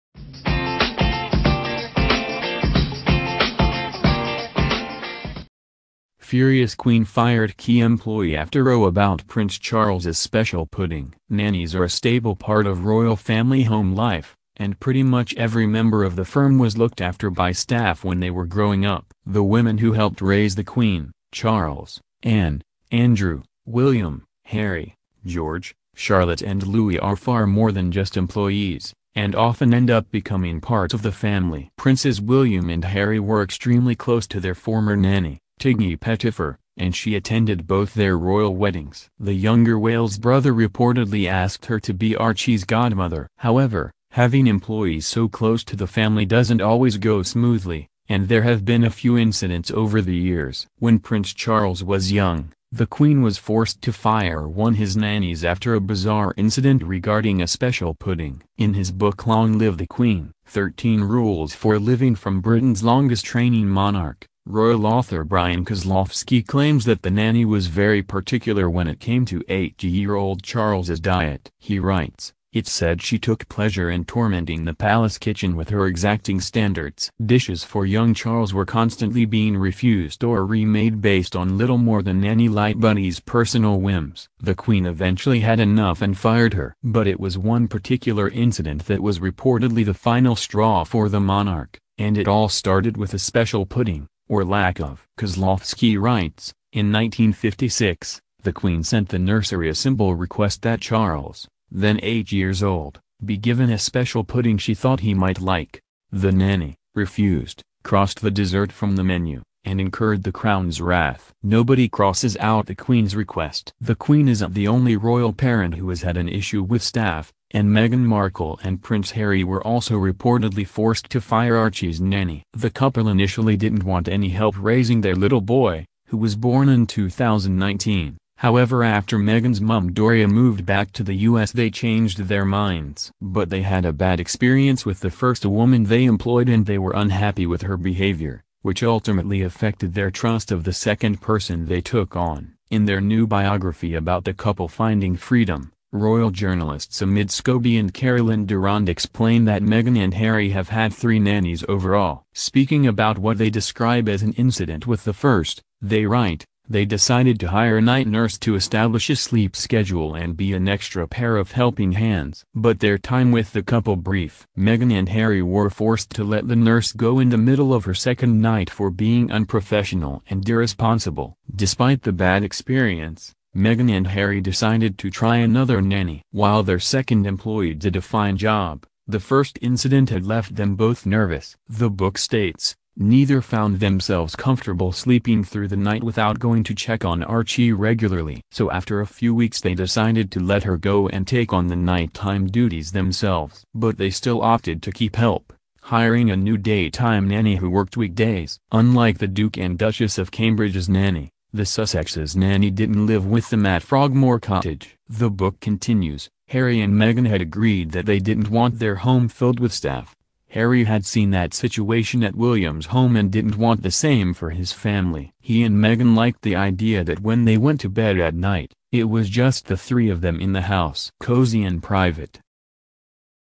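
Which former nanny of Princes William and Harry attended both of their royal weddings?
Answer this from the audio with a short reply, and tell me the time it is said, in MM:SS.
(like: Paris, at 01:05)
Tiggy Pettifer, at 00:35.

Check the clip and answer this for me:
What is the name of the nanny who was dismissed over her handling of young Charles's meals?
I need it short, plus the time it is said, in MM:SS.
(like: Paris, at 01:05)
Nanny Lightbody, at 01:22.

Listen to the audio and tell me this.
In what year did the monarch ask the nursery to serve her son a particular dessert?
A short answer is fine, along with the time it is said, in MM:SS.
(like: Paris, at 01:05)
1956, at 01:36.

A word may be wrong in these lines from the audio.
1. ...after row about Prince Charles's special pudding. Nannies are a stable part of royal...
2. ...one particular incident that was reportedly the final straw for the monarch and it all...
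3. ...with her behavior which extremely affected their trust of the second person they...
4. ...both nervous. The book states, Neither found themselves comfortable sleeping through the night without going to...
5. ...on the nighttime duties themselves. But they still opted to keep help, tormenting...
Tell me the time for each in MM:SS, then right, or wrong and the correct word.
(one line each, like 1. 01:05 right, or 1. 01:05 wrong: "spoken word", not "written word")
1. 00:08 right
2. 01:27 right
3. 02:17 wrong: "ultimately", not "extremely"
4. 03:00 right
5. 03:11 wrong: "hiring", not "tormenting".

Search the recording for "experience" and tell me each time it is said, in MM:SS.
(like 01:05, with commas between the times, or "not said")
02:14, 02:52.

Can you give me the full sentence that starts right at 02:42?
But their time with the couple brief.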